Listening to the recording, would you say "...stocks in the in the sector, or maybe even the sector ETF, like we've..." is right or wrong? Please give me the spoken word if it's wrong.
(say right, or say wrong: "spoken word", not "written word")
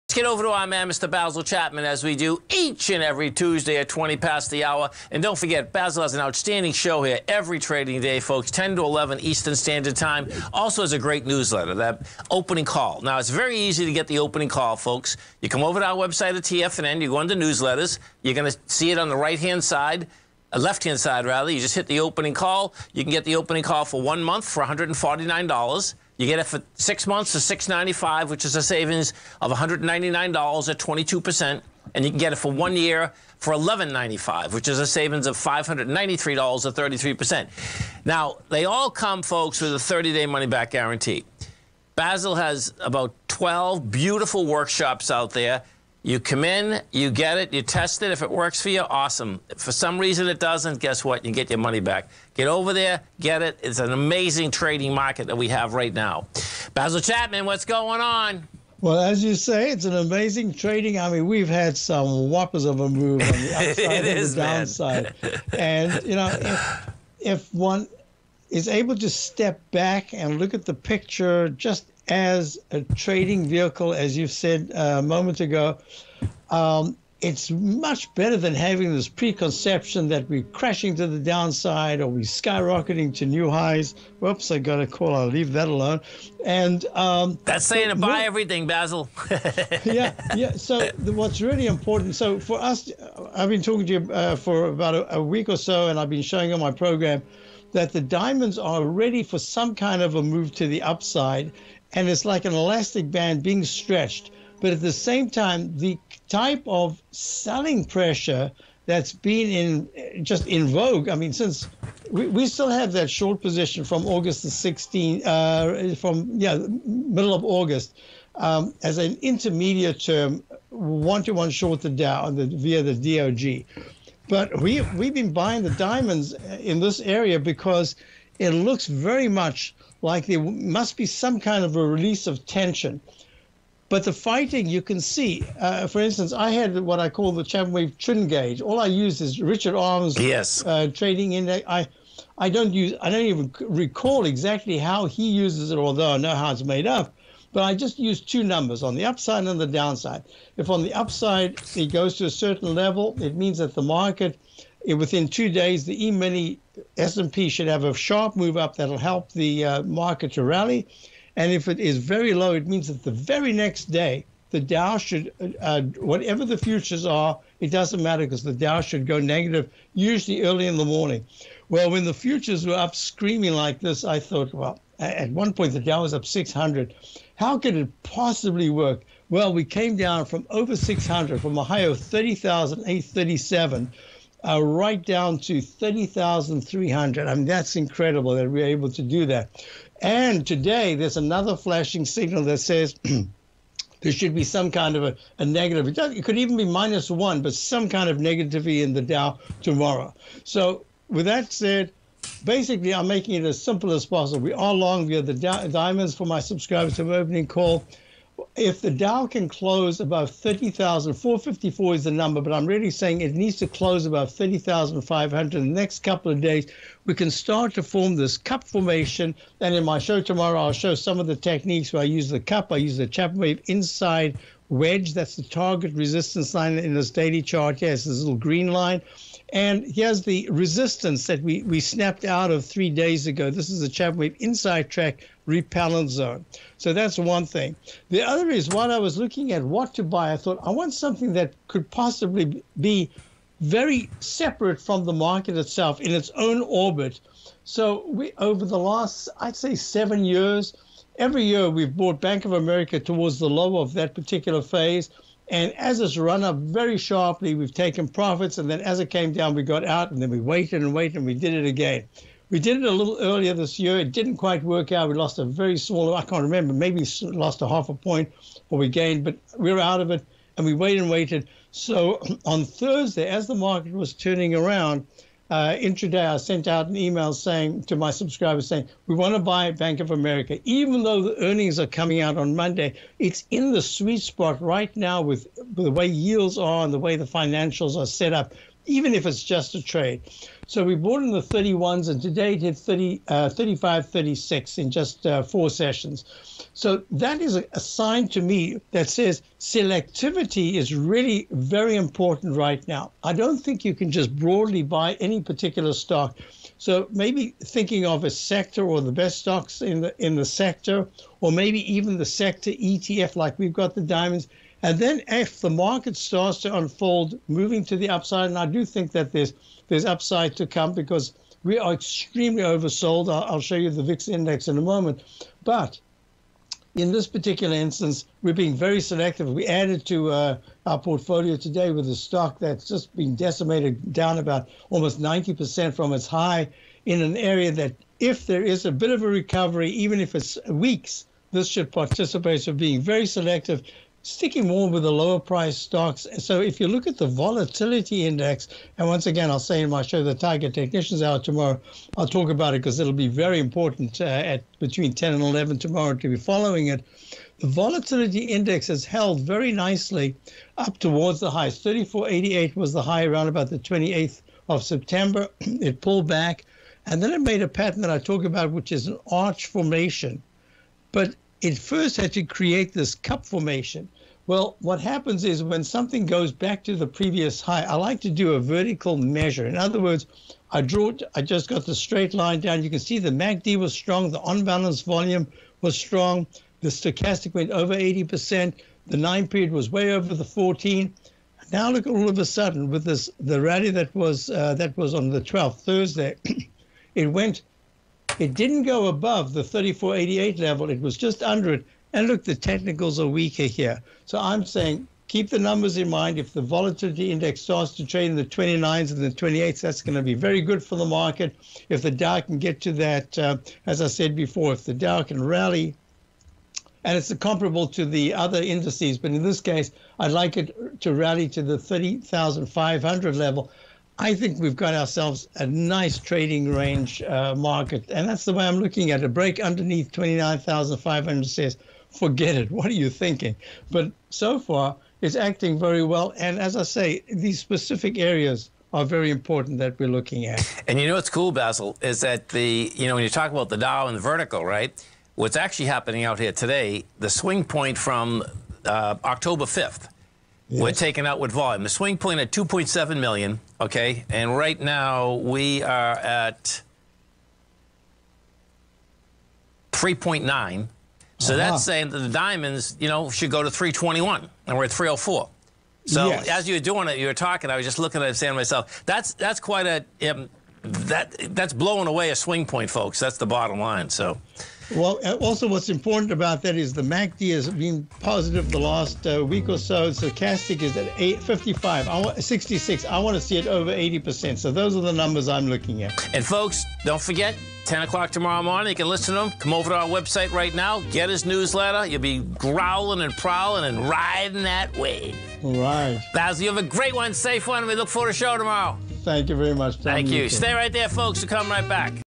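right.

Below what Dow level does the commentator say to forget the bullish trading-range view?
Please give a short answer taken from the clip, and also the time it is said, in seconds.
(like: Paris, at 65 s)
29,500, at 430 s.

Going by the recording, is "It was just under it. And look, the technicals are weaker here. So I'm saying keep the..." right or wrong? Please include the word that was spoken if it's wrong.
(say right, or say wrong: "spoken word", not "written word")
right.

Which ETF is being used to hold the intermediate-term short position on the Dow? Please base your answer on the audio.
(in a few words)
DOG.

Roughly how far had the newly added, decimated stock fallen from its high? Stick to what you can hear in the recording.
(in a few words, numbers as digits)
almost 90%.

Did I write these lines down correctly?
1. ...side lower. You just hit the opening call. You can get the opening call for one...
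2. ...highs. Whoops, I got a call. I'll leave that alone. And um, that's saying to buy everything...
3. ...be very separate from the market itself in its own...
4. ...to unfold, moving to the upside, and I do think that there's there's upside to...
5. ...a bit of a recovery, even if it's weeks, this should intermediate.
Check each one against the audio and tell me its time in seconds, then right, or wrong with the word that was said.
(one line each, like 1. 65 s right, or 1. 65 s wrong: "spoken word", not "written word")
1. 20 s wrong: "rather", not "lower"
2. 83 s right
3. 242 s right
4. 316 s right
5. 338 s wrong: "participate", not "intermediate".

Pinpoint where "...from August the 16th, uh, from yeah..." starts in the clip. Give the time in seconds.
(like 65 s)
113 s.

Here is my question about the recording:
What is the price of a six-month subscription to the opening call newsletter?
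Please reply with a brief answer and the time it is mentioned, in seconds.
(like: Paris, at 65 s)
$695, at 27 s.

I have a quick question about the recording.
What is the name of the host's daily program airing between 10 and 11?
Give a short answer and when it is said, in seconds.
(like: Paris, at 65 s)
Tiger Technicians Hour, at 350 s.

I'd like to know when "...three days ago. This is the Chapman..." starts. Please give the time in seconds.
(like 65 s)
232 s.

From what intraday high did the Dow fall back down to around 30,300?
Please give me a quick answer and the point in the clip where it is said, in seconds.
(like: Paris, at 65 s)
30,837, at 181 s.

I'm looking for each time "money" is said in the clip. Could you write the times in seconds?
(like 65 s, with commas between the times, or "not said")
40 s, 51 s.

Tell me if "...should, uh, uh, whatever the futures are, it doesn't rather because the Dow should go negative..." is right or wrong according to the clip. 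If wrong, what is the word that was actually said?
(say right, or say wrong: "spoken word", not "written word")
wrong: "matter", not "rather".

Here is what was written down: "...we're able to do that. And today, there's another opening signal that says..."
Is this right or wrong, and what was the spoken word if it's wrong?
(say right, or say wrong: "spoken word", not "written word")
wrong: "flashing", not "opening".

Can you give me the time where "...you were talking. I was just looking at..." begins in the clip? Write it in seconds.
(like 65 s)
467 s.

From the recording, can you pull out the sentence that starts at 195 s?
It, could even be minus one, but some kind of negativity in the Dow tomorrow.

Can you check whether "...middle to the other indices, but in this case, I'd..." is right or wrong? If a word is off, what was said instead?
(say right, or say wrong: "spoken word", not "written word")
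wrong: "comparable", not "middle".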